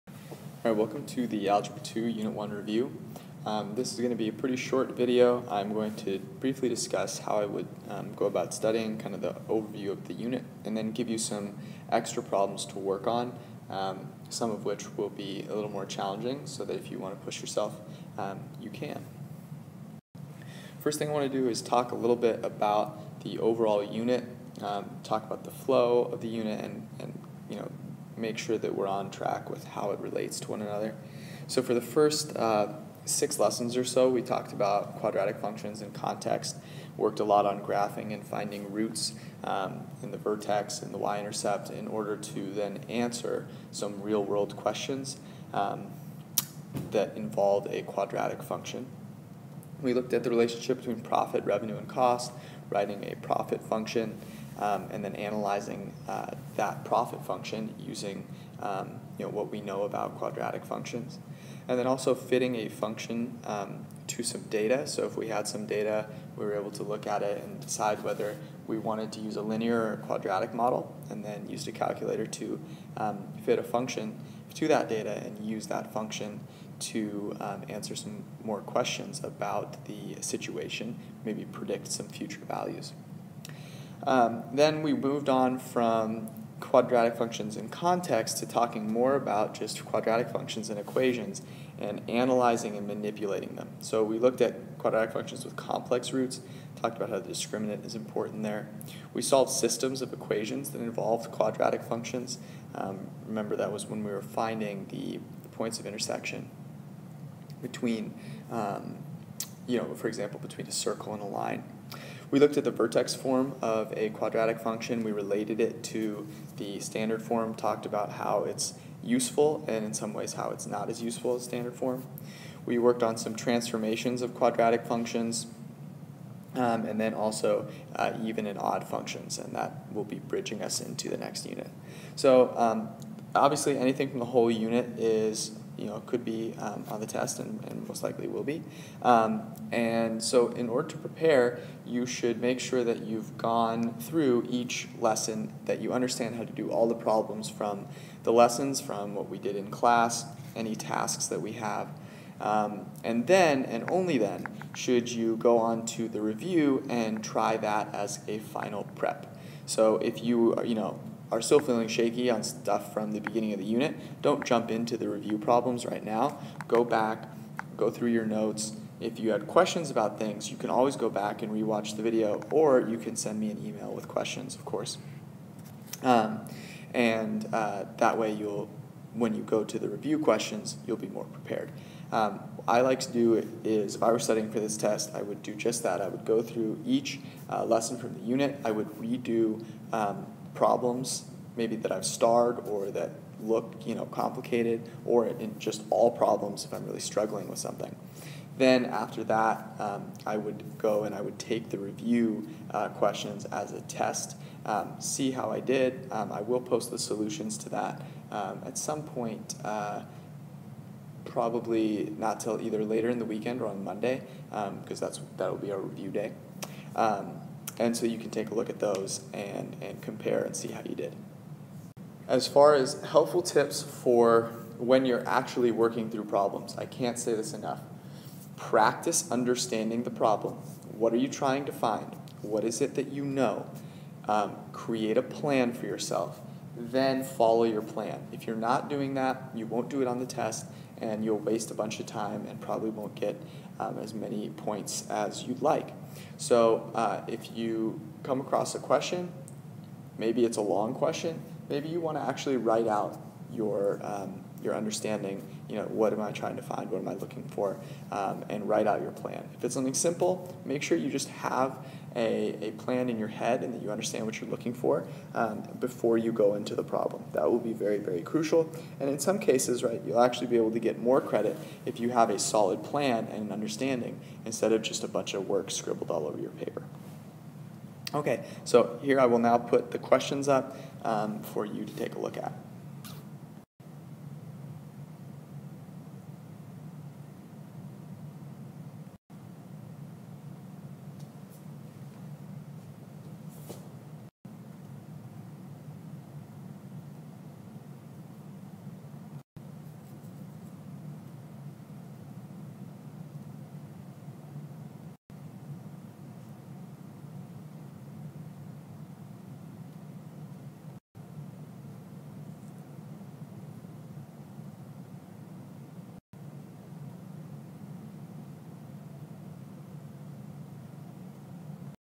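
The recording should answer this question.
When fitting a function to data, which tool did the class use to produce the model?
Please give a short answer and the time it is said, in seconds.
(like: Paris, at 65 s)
a calculator, at 71 s.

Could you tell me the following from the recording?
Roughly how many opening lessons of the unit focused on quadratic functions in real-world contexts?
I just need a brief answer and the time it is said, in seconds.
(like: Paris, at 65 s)
6, at 33 s.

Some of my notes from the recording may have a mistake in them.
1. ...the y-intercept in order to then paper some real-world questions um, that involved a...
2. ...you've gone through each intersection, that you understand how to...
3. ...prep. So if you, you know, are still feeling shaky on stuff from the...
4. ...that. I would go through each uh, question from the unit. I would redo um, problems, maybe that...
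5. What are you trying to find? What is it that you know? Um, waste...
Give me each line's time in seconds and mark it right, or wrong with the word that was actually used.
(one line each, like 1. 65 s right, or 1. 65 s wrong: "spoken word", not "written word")
1. 40 s wrong: "answer", not "paper"
2. 143 s wrong: "lesson", not "intersection"
3. 158 s right
4. 185 s wrong: "lesson", not "question"
5. 230 s wrong: "create", not "waste".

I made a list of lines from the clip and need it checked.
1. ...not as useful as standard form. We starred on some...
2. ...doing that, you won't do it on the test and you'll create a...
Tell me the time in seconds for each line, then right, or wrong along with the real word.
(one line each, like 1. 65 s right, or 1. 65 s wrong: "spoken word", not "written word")
1. 120 s wrong: "worked", not "starred"
2. 238 s wrong: "waste", not "create".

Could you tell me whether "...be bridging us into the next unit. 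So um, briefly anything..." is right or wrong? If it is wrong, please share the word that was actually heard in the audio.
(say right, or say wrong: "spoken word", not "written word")
wrong: "obviously", not "briefly".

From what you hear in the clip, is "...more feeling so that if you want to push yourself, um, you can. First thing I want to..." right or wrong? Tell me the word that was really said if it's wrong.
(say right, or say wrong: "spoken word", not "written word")
wrong: "challenging", not "feeling".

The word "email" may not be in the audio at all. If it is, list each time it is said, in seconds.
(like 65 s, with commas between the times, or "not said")
173 s.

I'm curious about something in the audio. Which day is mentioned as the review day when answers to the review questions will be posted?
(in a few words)
Monday.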